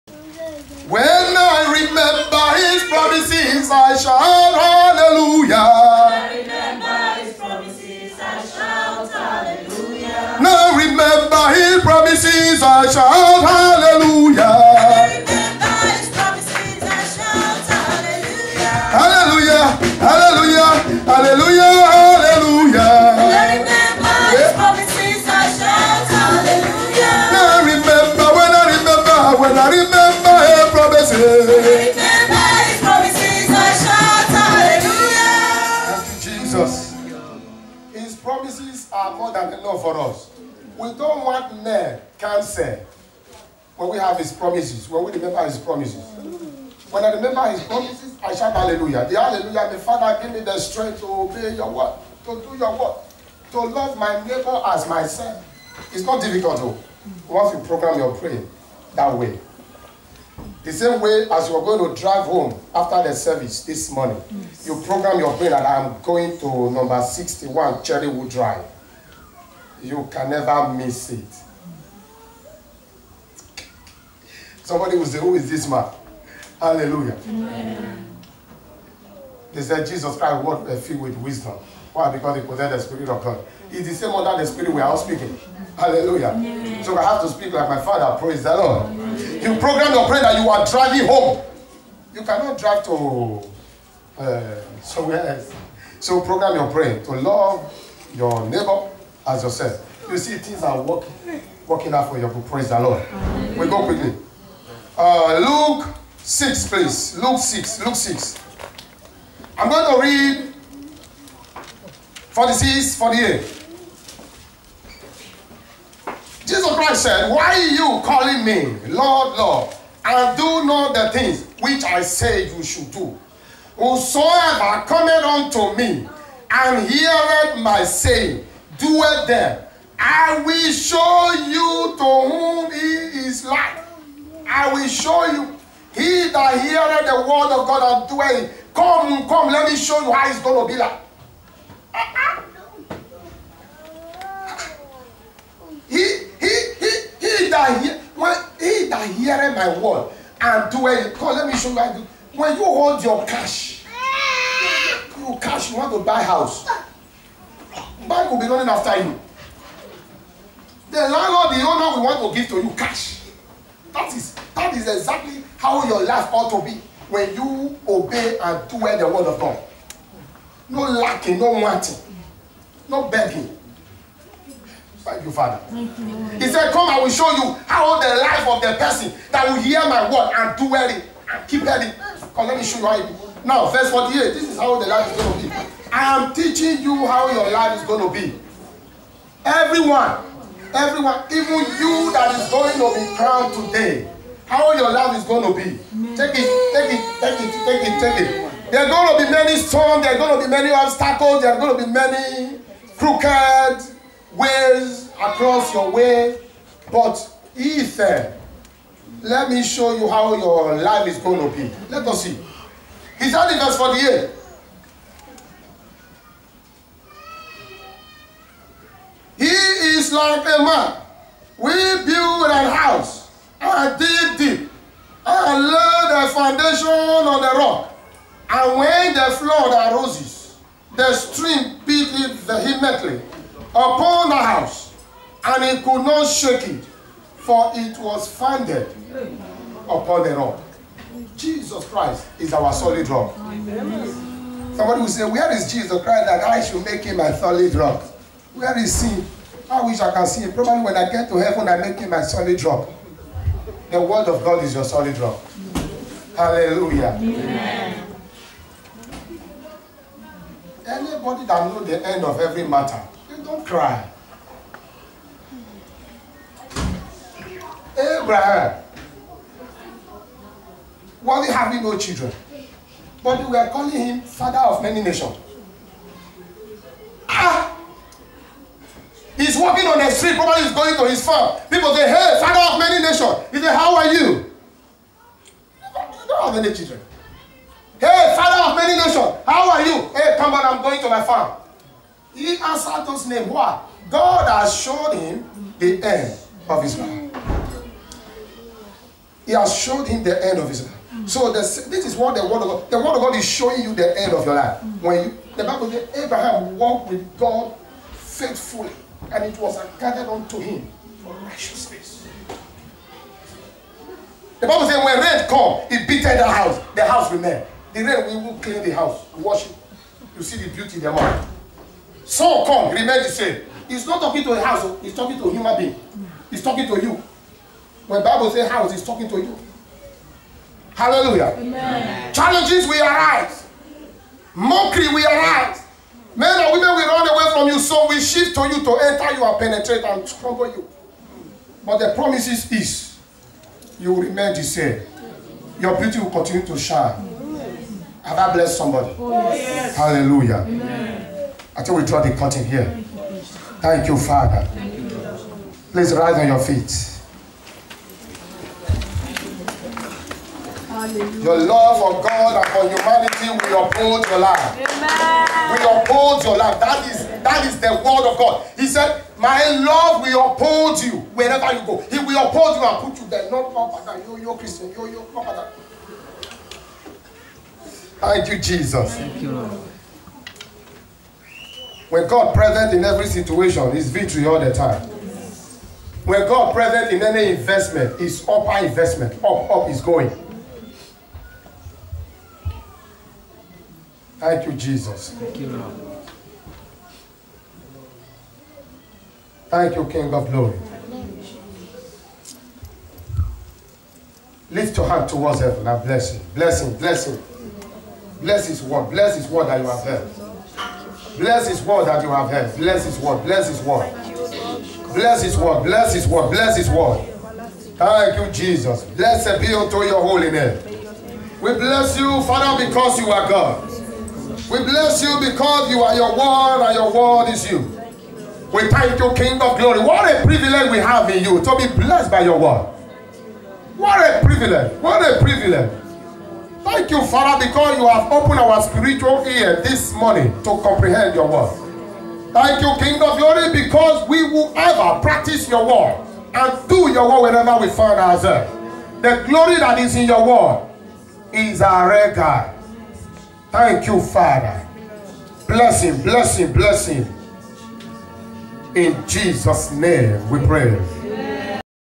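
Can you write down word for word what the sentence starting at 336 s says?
Men and women will run so will shift to you to enter you and penetrate and trouble you.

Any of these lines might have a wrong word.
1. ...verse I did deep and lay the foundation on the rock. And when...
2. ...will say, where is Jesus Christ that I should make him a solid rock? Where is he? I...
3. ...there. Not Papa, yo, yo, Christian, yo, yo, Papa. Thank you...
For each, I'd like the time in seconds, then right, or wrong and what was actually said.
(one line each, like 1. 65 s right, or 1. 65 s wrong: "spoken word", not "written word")
1. 222 s wrong: "house", not "verse"
2. 245 s right
3. 373 s right.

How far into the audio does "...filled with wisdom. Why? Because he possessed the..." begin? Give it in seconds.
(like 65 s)
80 s.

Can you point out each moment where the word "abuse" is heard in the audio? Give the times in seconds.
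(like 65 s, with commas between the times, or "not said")
not said.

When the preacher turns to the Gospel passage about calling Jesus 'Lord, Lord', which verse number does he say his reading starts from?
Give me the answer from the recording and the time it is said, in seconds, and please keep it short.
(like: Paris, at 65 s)
46, at 112 s.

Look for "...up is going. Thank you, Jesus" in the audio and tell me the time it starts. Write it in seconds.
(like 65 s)
389 s.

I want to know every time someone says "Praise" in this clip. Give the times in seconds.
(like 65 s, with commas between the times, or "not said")
88 s, 102 s.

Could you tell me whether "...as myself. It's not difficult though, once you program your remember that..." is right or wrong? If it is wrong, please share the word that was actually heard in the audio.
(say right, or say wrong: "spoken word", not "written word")
wrong: "prayer", not "remember".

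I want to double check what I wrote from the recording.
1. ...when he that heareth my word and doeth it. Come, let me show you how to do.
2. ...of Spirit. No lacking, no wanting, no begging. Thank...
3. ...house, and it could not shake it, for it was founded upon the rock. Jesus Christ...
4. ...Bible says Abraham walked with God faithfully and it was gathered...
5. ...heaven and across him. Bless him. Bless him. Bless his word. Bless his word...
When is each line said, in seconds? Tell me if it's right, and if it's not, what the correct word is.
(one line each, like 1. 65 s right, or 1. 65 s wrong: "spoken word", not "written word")
1. 148 s right
2. 169 s wrong: "God", not "Spirit"
3. 234 s right
4. 305 s right
5. 405 s wrong: "bless", not "across".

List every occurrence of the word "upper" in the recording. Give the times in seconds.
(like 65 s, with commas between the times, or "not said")
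388 s.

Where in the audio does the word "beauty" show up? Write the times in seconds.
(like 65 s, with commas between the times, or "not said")
320 s, 345 s.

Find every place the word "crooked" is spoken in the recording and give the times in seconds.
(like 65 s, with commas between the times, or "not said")
202 s.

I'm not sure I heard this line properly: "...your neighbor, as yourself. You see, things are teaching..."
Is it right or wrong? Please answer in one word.
wrong.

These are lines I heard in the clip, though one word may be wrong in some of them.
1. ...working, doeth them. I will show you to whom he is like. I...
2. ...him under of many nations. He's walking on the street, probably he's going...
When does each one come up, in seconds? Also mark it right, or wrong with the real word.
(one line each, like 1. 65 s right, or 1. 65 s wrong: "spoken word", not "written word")
1. 127 s wrong: "saying", not "working"
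2. 273 s wrong: "father", not "under".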